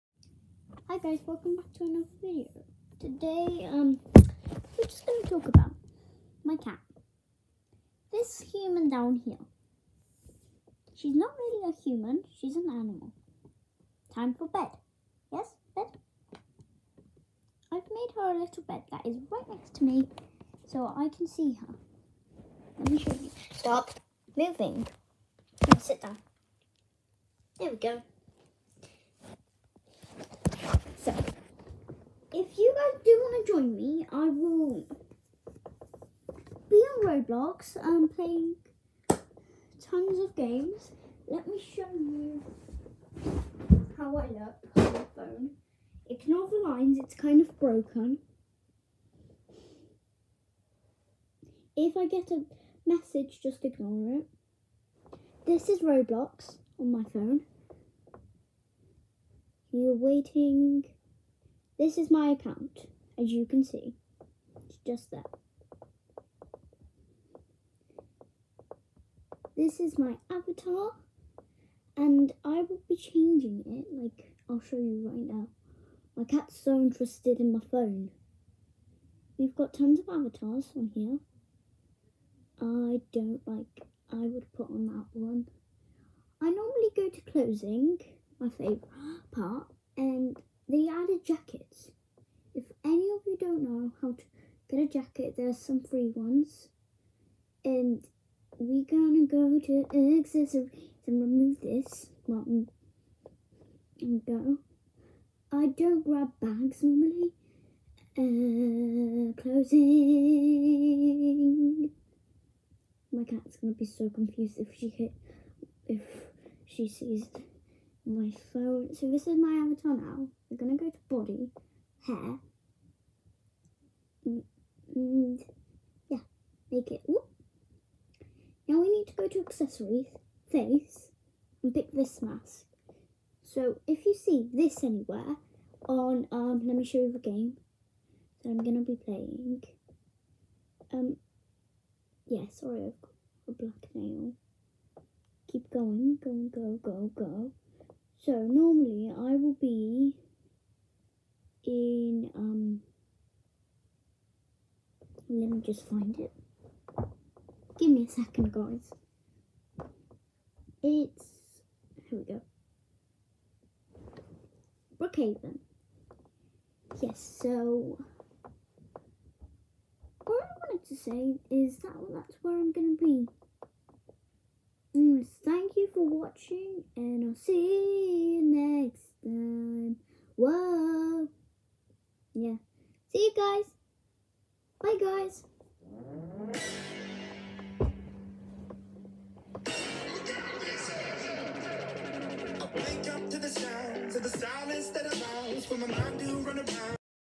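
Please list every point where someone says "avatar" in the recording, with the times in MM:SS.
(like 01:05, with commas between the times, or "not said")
01:10, 01:20, 01:59.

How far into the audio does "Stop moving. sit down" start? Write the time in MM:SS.
00:23.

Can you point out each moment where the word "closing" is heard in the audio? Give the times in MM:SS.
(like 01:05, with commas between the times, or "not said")
01:27, 01:49.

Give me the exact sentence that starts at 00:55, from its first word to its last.
This is Roblox on my phone.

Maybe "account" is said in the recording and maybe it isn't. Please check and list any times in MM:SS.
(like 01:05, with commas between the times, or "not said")
01:02.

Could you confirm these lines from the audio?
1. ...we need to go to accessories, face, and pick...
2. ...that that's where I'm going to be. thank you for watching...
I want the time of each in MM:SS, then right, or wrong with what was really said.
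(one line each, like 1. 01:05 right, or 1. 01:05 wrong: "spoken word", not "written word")
1. 02:08 right
2. 02:51 right.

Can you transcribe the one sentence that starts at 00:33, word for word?
join me, I will be on Roblox and um, playing tons of games.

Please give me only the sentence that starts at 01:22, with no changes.
I don't like, I would put on that one.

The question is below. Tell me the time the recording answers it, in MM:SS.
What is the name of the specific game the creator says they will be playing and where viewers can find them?
02:44.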